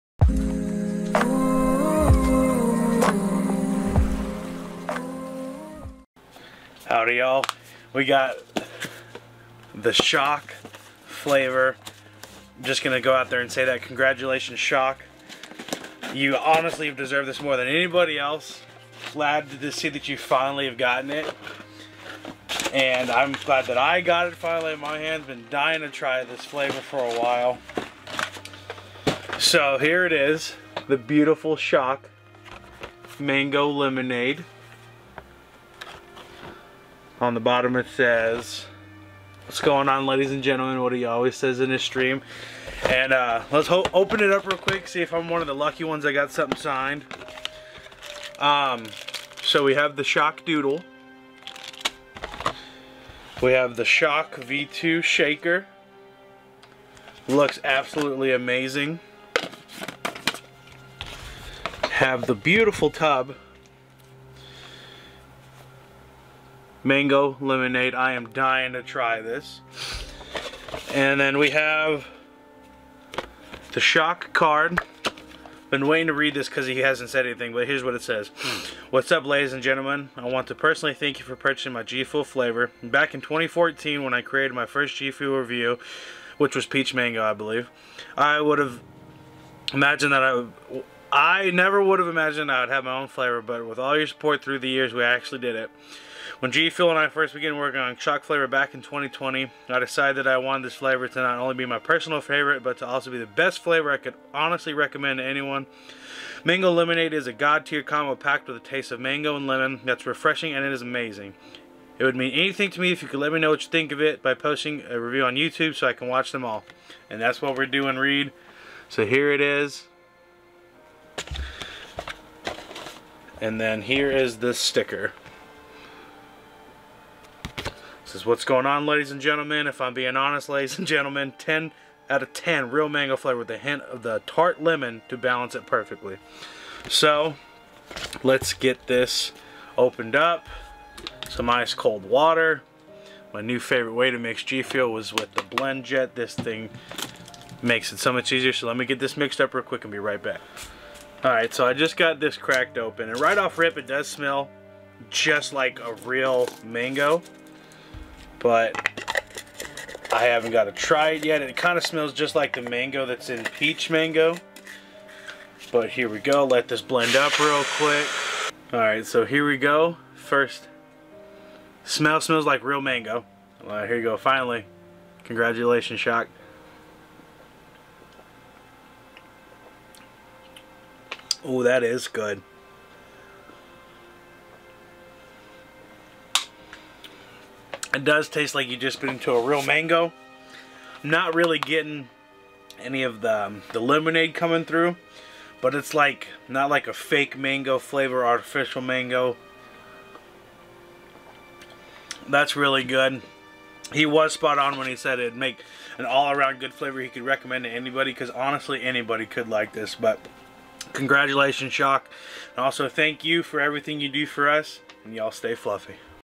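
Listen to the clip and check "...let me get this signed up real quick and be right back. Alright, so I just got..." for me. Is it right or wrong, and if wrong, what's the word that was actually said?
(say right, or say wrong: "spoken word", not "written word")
wrong: "mixed", not "signed".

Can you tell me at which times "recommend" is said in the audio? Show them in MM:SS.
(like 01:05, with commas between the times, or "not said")
01:44, 03:27.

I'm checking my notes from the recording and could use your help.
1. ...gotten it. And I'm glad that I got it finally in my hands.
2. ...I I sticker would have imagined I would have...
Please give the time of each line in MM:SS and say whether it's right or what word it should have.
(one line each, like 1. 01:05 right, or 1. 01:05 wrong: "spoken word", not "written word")
1. 00:20 right
2. 01:30 wrong: "never", not "sticker".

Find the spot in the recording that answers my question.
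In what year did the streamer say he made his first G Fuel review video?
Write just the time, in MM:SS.
01:23.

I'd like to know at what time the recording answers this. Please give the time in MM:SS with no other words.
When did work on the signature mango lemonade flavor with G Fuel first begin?
01:38.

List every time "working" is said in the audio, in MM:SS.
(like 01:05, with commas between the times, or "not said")
01:37.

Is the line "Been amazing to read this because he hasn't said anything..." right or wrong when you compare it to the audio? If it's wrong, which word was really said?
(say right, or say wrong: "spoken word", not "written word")
wrong: "waiting", not "amazing".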